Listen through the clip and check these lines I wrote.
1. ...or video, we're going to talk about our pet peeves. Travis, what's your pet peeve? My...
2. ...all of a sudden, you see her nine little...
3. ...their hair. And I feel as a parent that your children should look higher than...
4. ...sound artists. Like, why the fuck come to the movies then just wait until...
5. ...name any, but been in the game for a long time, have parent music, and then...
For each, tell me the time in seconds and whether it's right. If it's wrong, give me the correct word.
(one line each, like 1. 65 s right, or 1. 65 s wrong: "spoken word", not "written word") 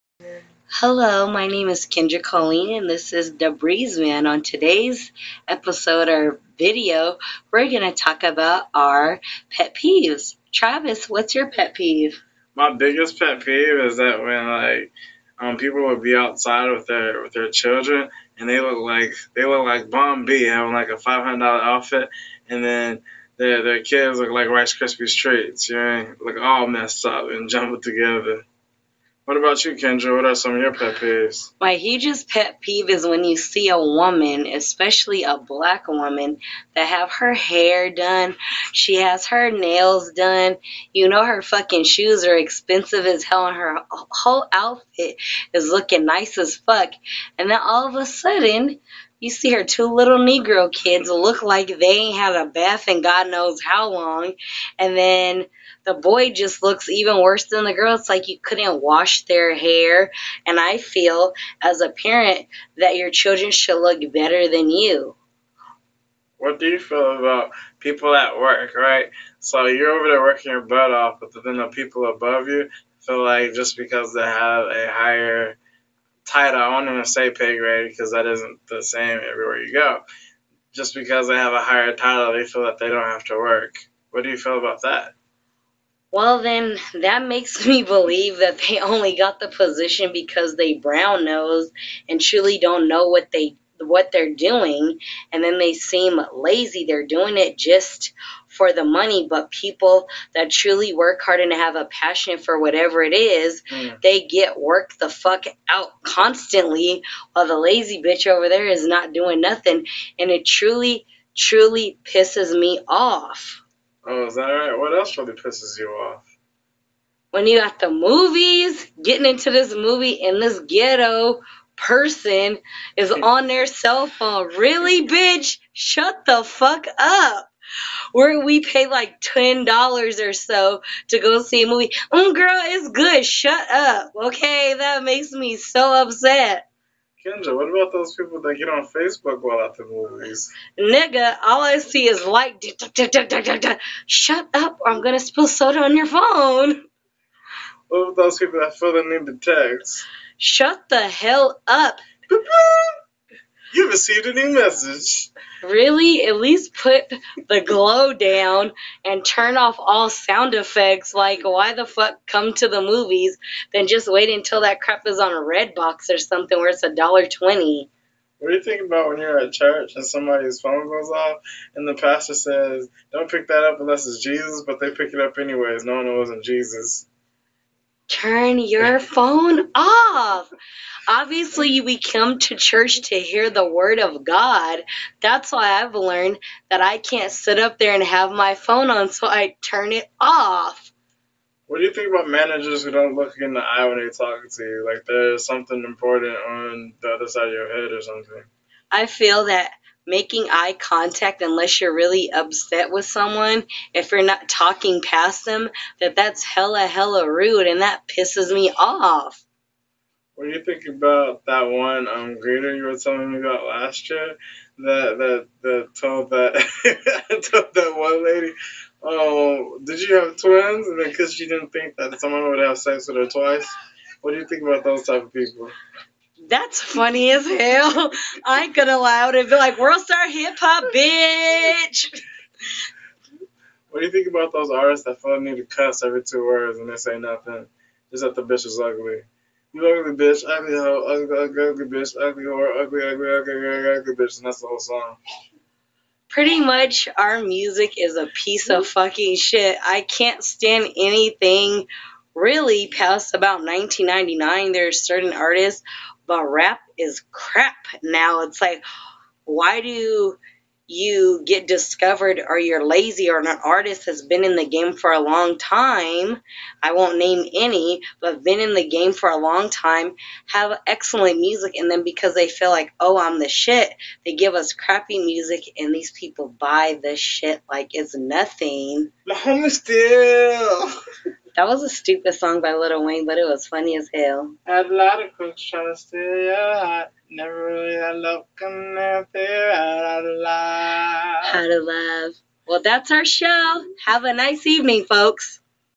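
1. 6 s right
2. 47 s wrong: "two", not "nine"
3. 59 s wrong: "better", not "higher"
4. 160 s wrong: "effects", not "artists"
5. 267 s wrong: "excellent", not "parent".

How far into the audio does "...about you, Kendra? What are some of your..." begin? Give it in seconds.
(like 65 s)
29 s.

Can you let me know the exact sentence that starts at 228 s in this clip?
I ain't gonna lie, I would be like, world star hip hop, bitch.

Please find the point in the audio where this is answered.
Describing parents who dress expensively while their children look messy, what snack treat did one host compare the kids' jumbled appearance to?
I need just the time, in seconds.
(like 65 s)
24 s.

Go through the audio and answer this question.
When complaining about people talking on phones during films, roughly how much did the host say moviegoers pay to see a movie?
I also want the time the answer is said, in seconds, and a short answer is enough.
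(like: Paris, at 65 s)
$10, at 129 s.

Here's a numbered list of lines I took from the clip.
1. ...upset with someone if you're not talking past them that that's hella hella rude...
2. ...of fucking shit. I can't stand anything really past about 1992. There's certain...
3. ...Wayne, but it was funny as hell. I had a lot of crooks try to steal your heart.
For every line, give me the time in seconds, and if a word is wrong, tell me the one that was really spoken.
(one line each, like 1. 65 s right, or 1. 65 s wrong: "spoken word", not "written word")
1. 202 s right
2. 248 s wrong: "1999", not "1992"
3. 283 s right.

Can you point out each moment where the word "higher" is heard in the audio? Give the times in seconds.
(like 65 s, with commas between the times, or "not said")
74 s, 81 s.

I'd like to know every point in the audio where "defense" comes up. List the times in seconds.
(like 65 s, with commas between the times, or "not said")
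not said.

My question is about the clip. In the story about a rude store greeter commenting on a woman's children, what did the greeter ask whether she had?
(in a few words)
twins.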